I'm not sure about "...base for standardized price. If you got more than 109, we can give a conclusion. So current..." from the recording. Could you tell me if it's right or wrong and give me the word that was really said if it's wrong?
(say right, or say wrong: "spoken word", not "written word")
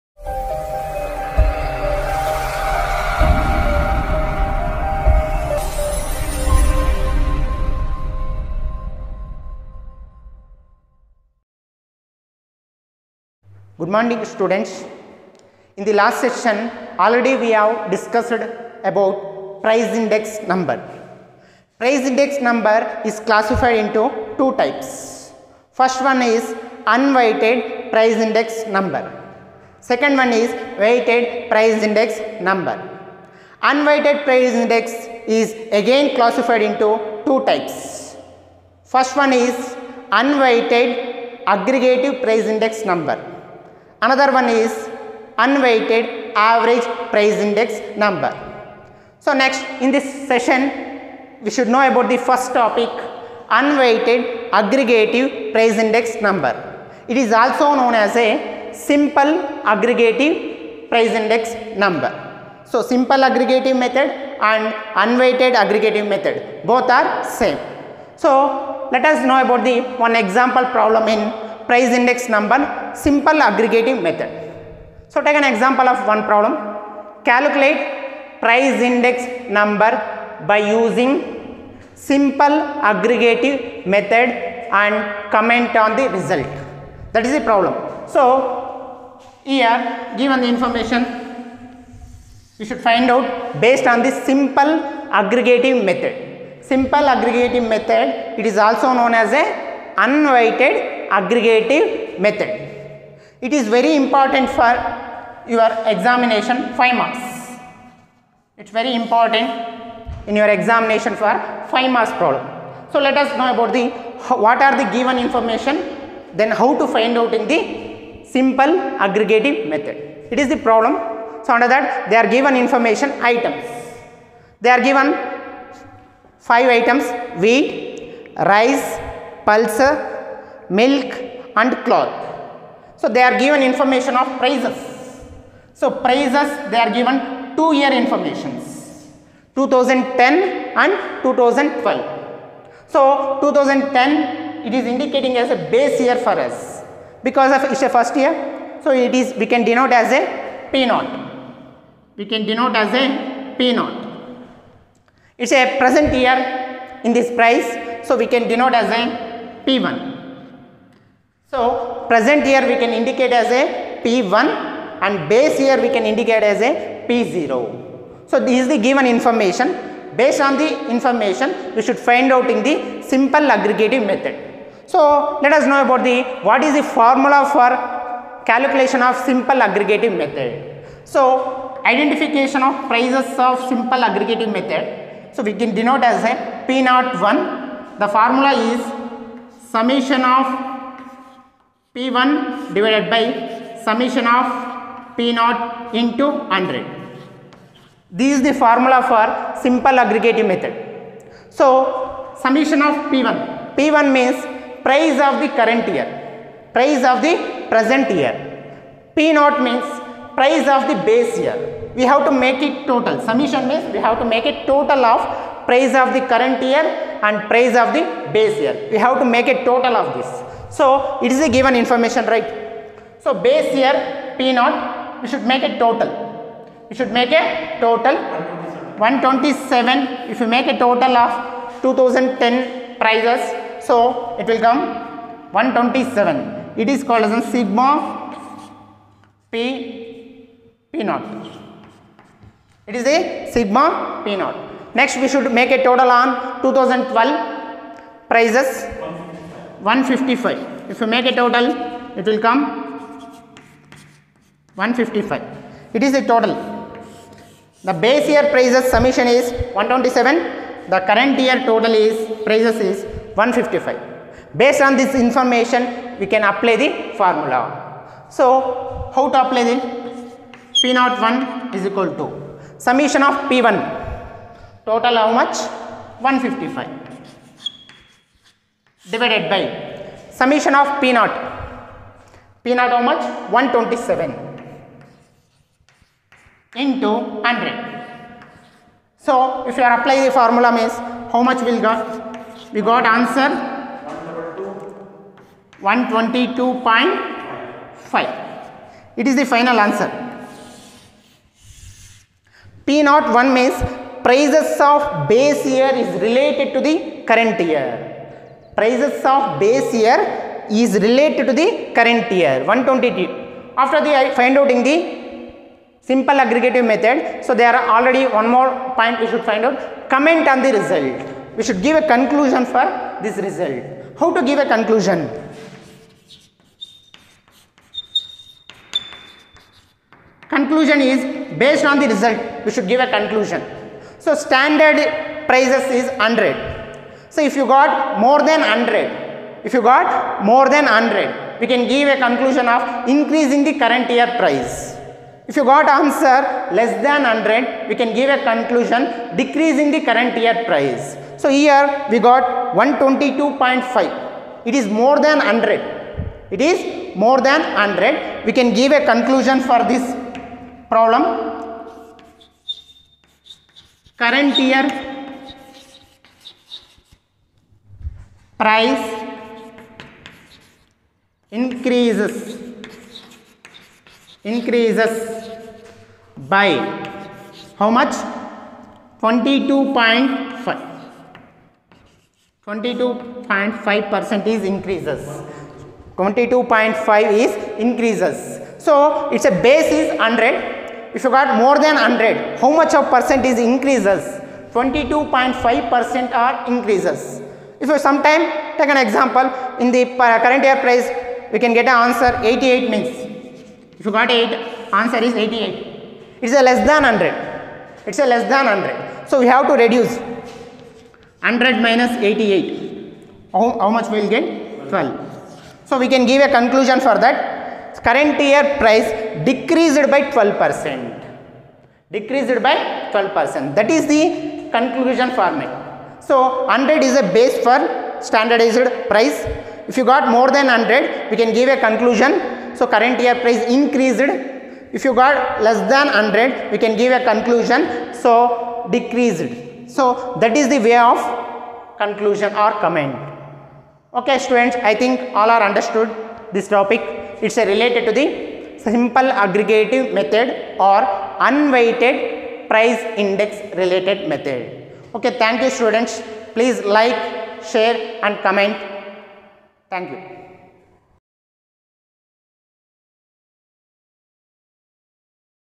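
wrong: "100", not "109".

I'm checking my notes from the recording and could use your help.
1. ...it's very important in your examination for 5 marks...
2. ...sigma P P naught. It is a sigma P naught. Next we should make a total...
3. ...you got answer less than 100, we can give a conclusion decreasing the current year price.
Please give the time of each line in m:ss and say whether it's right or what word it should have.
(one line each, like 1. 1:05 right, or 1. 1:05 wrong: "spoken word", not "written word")
1. 1:48 right
2. 3:57 right
3. 5:45 right.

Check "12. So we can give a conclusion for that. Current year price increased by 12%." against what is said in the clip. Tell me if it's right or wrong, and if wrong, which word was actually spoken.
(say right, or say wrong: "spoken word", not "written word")
wrong: "decreased", not "increased".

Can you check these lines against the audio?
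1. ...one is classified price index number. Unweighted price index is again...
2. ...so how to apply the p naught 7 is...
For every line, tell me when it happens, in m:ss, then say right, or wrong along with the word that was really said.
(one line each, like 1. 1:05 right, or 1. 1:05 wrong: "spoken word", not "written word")
1. 0:30 wrong: "weighted", not "classified"
2. 4:28 wrong: "1", not "7".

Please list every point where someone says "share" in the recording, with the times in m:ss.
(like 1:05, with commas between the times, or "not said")
7:37.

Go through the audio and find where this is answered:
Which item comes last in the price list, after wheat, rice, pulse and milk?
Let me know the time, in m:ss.
2:11.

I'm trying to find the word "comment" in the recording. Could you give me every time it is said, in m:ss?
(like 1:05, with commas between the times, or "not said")
1:25, 5:20, 7:22, 7:38.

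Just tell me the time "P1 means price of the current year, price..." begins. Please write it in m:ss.
3:23.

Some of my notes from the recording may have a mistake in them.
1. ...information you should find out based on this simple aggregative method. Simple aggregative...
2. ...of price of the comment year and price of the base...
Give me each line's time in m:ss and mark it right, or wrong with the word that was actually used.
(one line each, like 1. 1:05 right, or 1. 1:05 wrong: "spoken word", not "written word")
1. 1:30 right
2. 3:35 wrong: "current", not "comment".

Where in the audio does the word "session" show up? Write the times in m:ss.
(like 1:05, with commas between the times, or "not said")
0:16, 0:50.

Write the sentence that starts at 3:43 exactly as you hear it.
So base year P naught, we should make a total.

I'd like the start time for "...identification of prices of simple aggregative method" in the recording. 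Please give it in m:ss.
3:01.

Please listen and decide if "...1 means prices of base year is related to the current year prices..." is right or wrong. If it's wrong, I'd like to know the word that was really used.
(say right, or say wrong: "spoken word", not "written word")
right.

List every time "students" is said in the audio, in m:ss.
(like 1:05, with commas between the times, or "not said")
0:14, 7:24, 7:35.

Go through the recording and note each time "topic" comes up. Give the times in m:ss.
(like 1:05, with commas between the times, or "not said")
0:52, 7:26.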